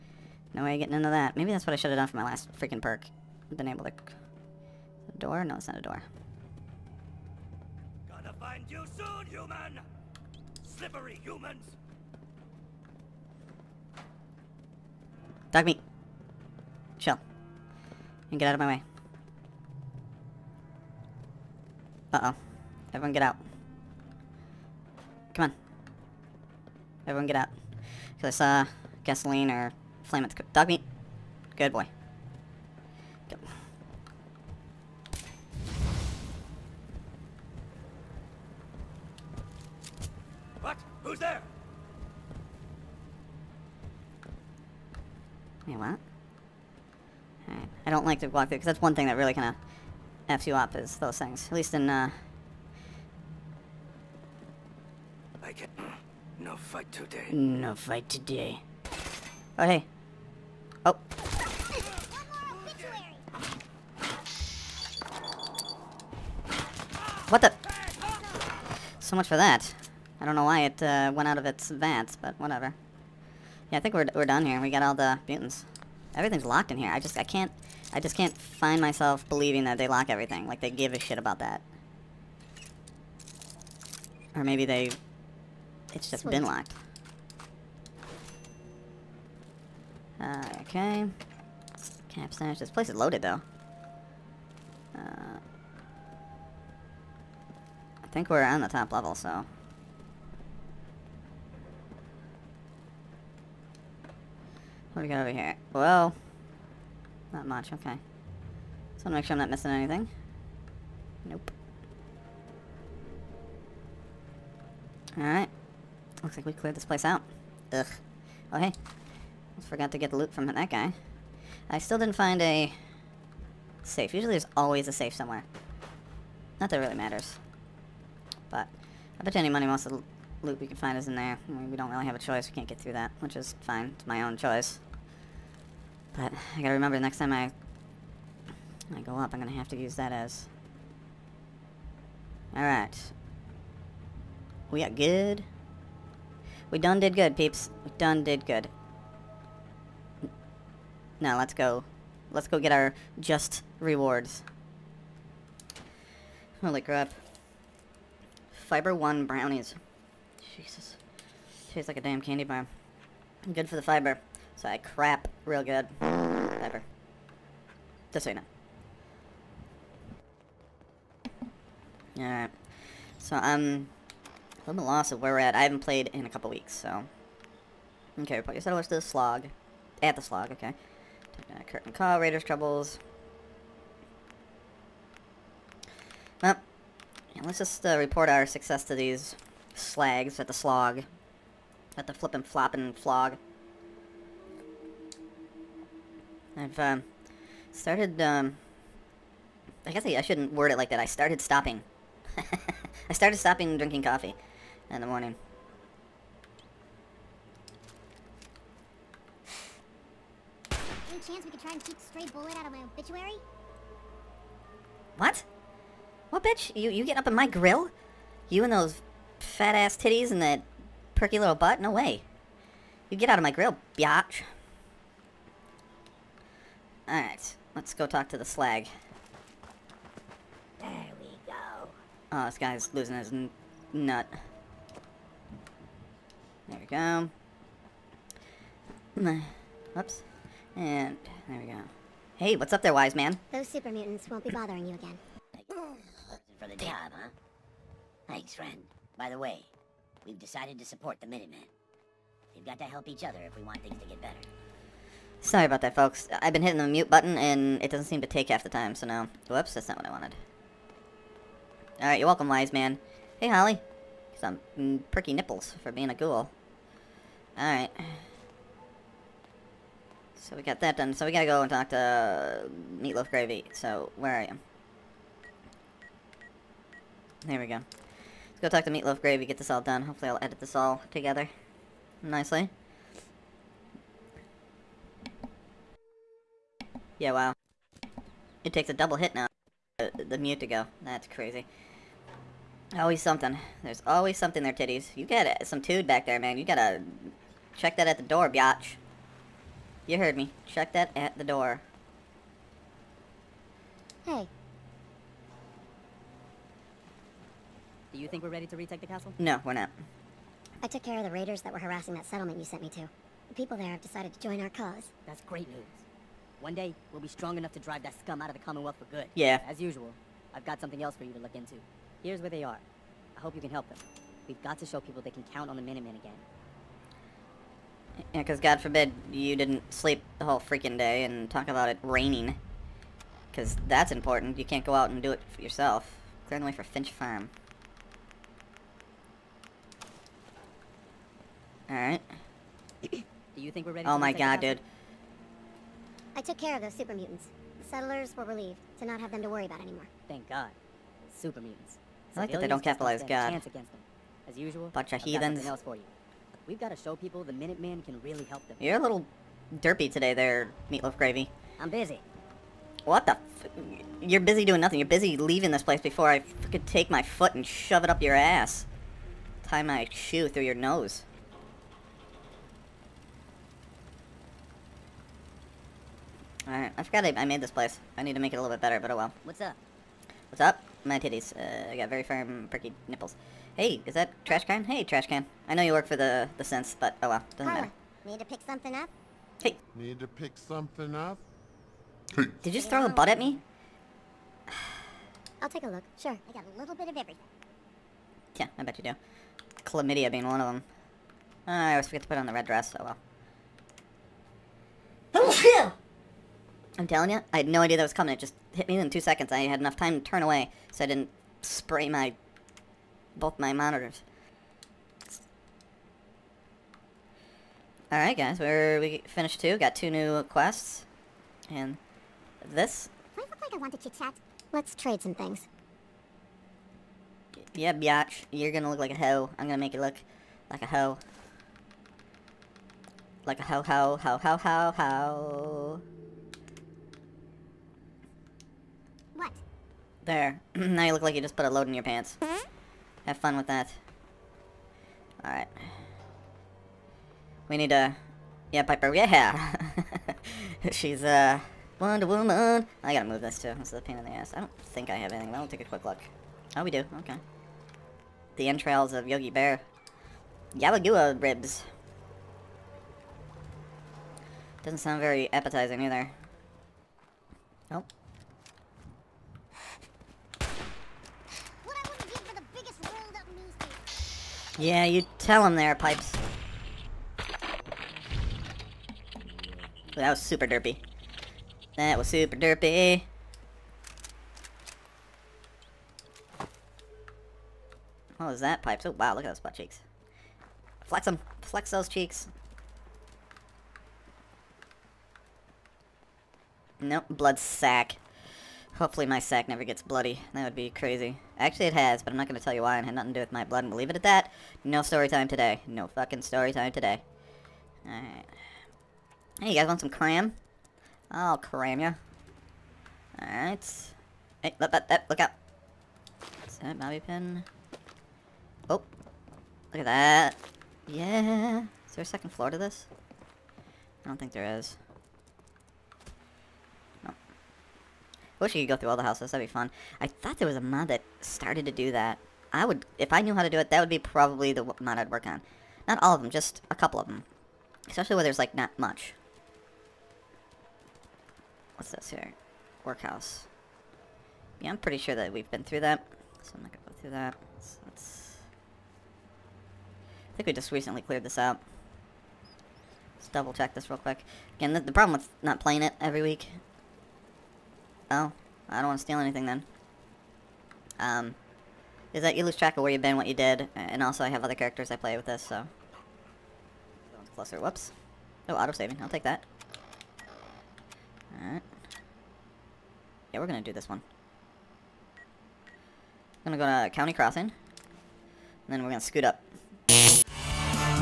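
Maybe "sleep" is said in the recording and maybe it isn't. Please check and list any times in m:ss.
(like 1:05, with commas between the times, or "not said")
5:29.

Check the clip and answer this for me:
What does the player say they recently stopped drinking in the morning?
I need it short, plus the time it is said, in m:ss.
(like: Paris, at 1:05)
Coffee, at 3:24.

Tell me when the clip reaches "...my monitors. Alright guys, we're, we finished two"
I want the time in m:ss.
6:53.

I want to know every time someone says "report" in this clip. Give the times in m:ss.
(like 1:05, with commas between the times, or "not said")
3:07.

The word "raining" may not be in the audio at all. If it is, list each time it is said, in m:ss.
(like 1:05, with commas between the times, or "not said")
5:32.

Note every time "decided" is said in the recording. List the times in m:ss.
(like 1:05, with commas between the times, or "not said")
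4:10, 5:13.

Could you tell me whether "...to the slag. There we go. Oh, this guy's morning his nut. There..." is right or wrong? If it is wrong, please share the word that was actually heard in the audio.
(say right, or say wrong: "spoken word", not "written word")
wrong: "losing", not "morning".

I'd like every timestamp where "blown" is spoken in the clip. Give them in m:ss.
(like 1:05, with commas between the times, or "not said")
not said.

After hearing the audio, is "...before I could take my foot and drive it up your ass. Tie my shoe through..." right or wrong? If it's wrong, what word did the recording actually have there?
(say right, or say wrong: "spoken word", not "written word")
wrong: "shove", not "drive".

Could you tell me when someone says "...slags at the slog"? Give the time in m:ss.
3:09.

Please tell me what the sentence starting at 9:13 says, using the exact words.
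Let's double check this real quick.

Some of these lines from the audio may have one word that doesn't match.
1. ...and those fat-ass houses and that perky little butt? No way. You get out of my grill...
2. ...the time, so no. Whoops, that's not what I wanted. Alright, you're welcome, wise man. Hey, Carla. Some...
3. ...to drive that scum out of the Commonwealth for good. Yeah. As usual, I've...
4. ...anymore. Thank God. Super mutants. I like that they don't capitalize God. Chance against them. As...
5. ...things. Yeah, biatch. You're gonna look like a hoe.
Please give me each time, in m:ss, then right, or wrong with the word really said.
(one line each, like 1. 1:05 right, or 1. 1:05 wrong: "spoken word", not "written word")
1. 3:38 wrong: "titties", not "houses"
2. 4:18 wrong: "Holly", not "Carla"
3. 5:17 right
4. 5:49 right
5. 7:05 right.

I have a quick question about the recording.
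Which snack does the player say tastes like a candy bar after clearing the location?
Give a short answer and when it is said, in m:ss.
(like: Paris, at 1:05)
Fiber 1 brownies, at 2:38.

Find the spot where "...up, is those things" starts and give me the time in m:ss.
0:50.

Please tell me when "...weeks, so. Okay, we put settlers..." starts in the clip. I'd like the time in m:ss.
2:56.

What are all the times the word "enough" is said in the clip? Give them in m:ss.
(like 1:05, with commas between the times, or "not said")
5:17, 6:49.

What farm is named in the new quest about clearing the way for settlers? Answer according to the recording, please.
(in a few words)
Finch Farm.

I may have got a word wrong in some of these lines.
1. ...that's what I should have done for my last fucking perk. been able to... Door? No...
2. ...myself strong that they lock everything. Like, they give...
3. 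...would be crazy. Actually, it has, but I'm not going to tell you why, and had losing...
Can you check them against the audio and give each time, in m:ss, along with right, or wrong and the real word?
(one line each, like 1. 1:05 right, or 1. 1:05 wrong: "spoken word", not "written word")
1. 0:01 wrong: "freaking", not "fucking"
2. 1:18 wrong: "believing", not "strong"
3. 8:20 wrong: "nothing", not "losing".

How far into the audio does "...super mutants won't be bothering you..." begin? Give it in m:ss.
4:03.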